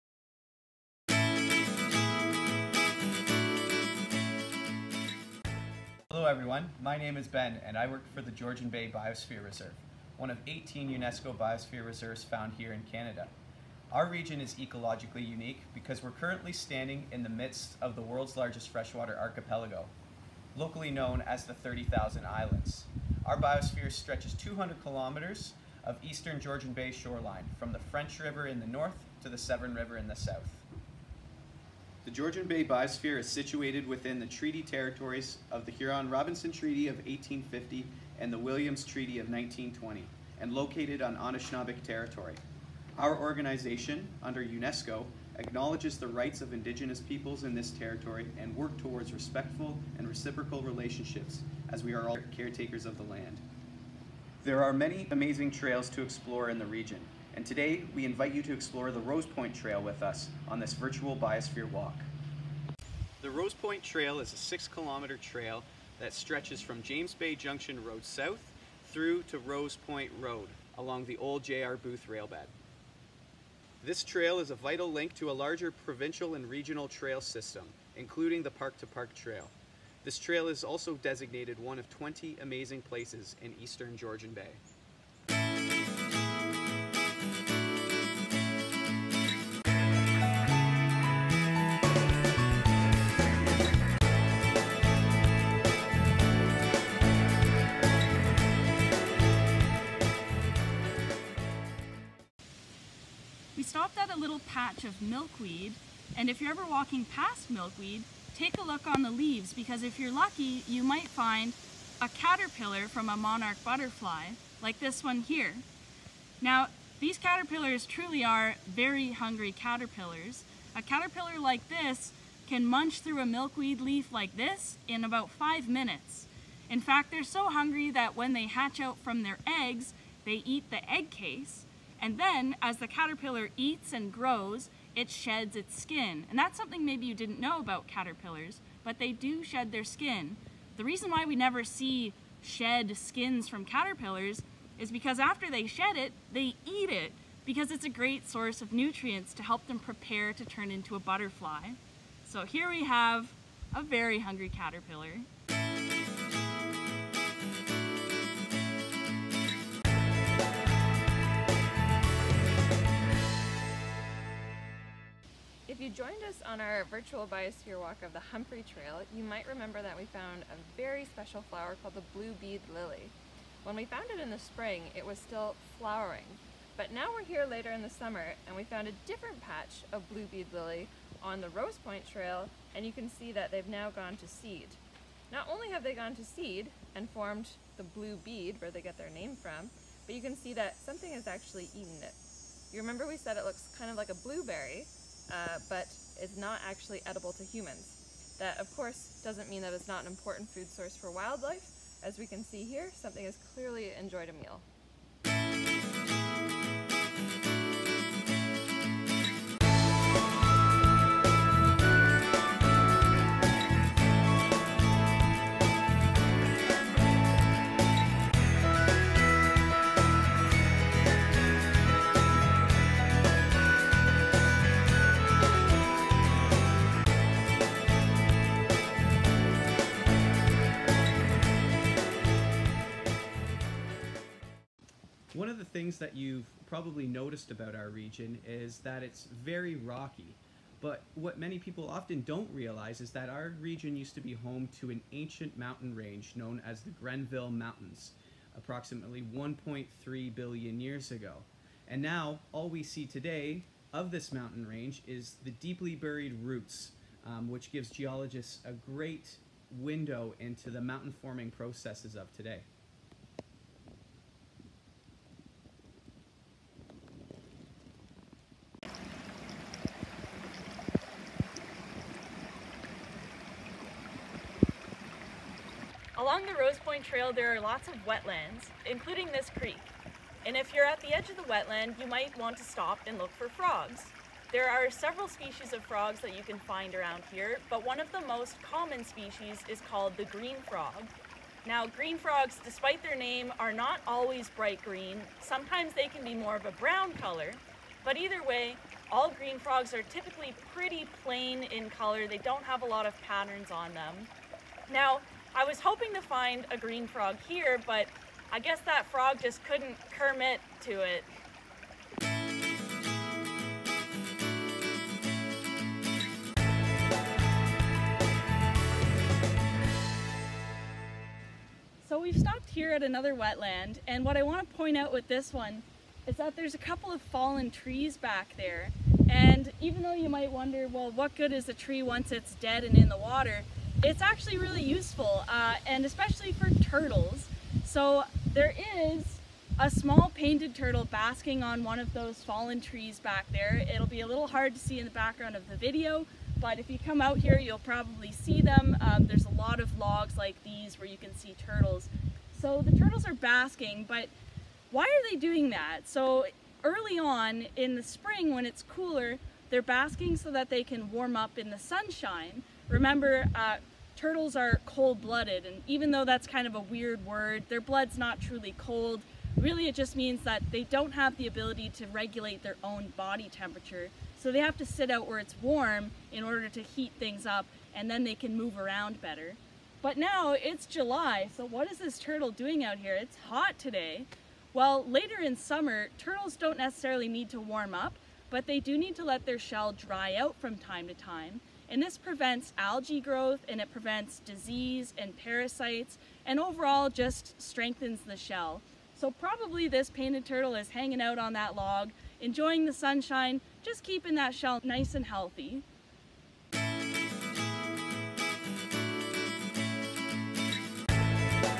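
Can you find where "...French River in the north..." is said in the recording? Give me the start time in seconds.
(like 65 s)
27 s.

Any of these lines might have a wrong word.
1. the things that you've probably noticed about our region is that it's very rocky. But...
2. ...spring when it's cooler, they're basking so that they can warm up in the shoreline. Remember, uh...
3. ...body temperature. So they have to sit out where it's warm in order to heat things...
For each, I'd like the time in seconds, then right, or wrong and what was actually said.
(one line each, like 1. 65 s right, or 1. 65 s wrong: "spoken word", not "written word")
1. 235 s right
2. 358 s wrong: "sunshine", not "shoreline"
3. 373 s right.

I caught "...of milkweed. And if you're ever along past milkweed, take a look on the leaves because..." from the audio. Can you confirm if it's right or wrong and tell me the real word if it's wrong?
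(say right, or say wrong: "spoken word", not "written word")
wrong: "walking", not "along".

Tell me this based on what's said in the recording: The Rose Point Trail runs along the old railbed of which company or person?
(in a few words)
J.R. Booth.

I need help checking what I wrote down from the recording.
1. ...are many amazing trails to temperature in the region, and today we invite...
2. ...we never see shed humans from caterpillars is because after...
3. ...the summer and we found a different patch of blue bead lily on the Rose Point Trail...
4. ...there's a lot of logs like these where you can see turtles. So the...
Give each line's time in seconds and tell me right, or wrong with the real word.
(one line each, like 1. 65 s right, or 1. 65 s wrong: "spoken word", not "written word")
1. 54 s wrong: "explore", not "temperature"
2. 141 s wrong: "skins", not "humans"
3. 177 s right
4. 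349 s right.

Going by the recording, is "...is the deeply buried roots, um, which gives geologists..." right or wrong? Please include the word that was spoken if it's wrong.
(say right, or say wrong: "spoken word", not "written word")
right.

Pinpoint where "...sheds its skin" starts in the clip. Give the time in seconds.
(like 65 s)
135 s.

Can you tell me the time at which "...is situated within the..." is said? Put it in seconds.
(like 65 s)
33 s.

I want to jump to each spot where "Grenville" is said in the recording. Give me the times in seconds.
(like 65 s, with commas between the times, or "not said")
246 s.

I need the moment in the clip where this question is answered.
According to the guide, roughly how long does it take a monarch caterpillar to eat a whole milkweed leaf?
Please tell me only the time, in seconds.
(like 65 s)
125 s.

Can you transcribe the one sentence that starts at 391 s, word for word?
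And this prevents algae growth and it prevents disease and parasites and overall just strengthens the shell.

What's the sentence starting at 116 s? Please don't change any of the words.
Now, these caterpillars truly are very hungry caterpillars.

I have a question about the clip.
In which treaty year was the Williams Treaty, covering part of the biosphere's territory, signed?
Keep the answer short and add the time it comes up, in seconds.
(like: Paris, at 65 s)
1920, at 39 s.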